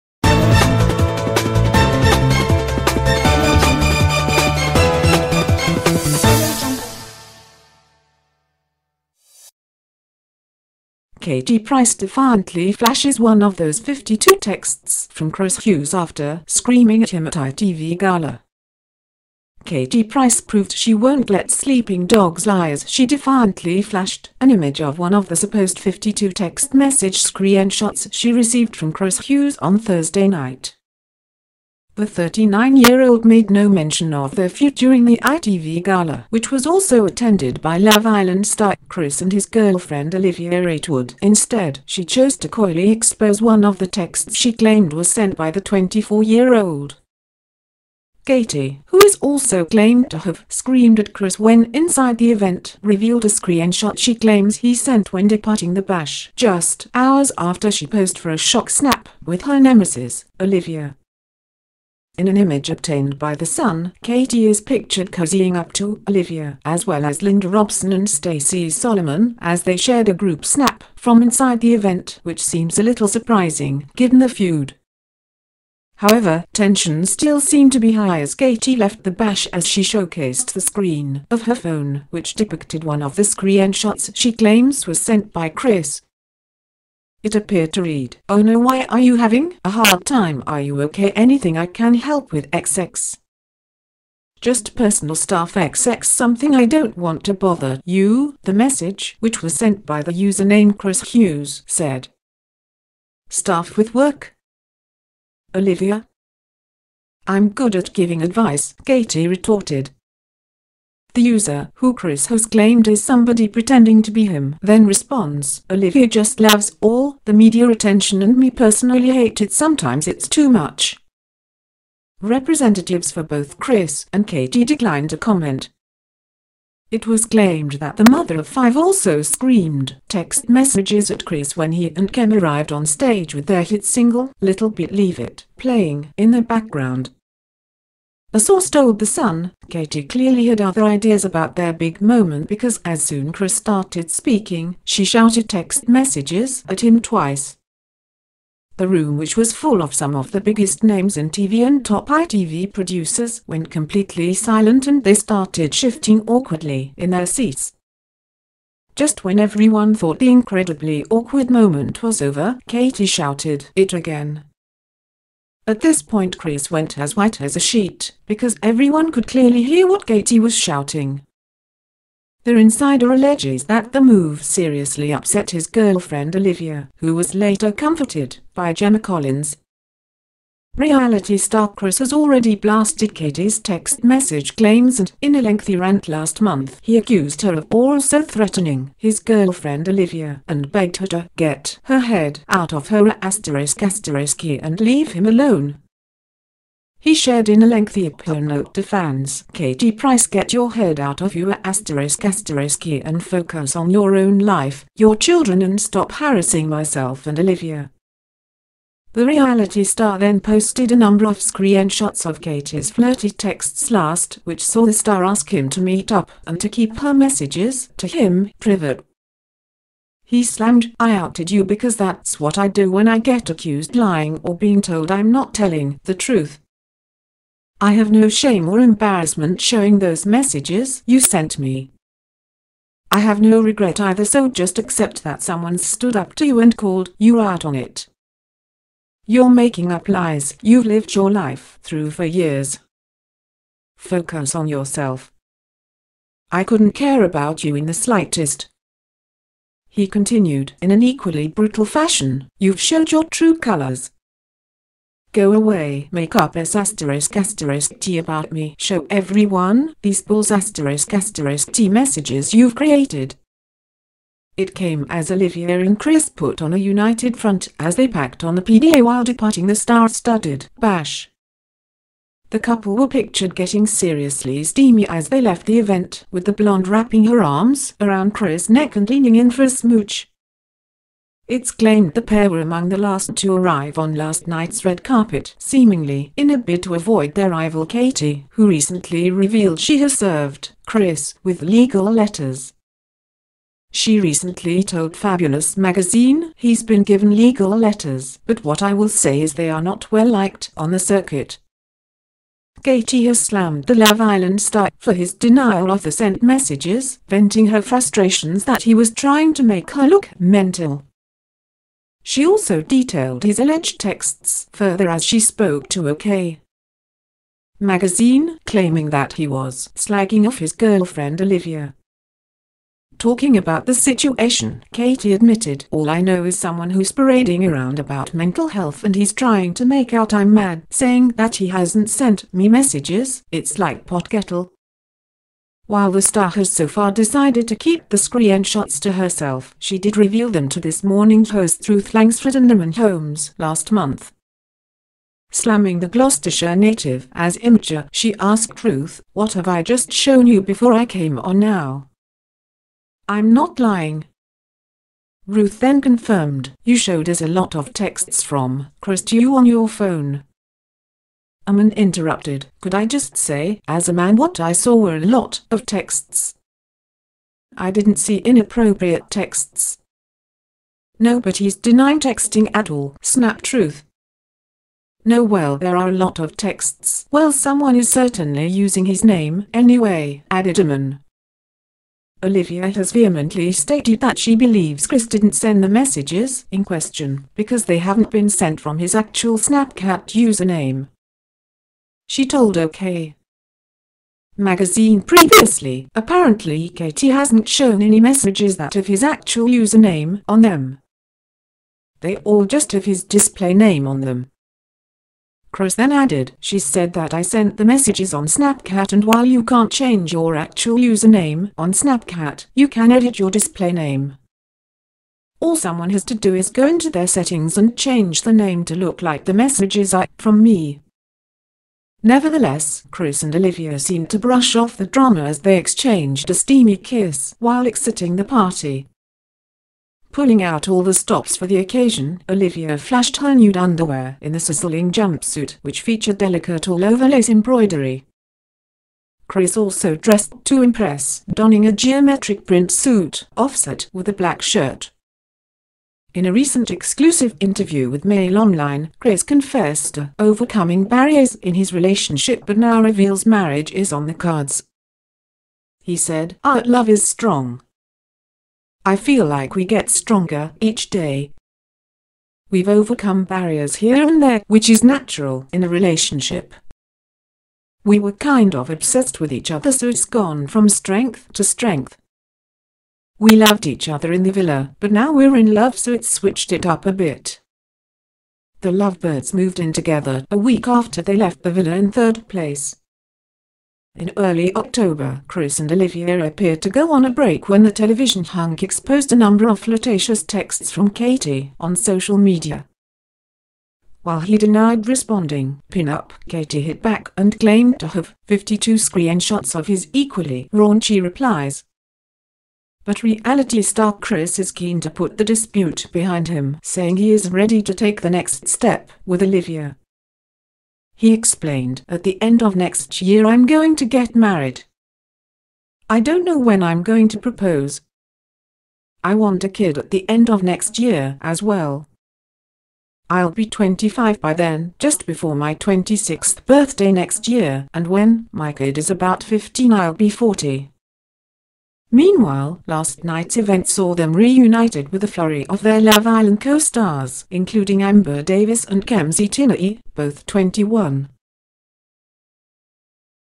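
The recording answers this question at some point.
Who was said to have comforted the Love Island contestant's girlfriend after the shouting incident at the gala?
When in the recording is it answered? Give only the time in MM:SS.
02:58.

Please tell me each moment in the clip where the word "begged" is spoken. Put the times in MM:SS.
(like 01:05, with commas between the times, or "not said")
03:10.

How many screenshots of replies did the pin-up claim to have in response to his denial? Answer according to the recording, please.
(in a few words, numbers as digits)
52.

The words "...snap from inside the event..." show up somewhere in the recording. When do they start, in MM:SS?
01:10.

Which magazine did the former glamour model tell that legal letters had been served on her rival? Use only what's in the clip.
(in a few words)
Fabulous.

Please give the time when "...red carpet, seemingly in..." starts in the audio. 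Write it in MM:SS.
04:44.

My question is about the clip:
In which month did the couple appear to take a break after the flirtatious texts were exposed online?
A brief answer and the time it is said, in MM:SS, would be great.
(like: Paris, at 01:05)
October, at 08:04.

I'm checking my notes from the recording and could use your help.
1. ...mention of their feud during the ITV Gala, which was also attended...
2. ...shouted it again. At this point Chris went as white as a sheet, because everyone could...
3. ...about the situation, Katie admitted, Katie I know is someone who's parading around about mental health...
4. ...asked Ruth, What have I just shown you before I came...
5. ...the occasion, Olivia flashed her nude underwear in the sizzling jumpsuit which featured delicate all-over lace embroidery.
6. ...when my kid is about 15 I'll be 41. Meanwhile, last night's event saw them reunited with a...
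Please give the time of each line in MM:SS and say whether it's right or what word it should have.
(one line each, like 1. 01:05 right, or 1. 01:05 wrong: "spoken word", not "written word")
1. 00:33 right
2. 02:43 right
3. 05:23 wrong: "All", not "Katie"
4. 05:48 right
5. 07:11 right
6. 08:48 wrong: "40", not "41".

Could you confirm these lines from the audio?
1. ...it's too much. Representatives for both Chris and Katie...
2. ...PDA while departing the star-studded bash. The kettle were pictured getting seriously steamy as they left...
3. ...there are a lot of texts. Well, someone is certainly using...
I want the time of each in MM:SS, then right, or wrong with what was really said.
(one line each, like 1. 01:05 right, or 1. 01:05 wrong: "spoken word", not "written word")
1. 02:00 right
2. 04:28 wrong: "couple", not "kettle"
3. 06:15 right.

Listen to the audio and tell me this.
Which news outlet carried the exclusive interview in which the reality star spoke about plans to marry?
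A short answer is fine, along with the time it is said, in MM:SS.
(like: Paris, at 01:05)
Mail Online, at 07:28.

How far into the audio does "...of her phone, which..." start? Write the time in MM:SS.
01:21.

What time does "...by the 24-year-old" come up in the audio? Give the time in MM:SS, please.
00:45.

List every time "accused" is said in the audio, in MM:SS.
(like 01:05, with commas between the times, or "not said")
03:06, 03:43.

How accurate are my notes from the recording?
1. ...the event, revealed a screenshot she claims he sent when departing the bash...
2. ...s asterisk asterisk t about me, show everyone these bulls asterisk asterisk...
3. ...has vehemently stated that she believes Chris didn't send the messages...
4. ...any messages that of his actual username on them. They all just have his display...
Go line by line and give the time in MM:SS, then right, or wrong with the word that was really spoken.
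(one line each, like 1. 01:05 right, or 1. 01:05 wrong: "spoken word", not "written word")
1. 00:52 right
2. 04:16 right
3. 06:22 right
4. 06:38 right.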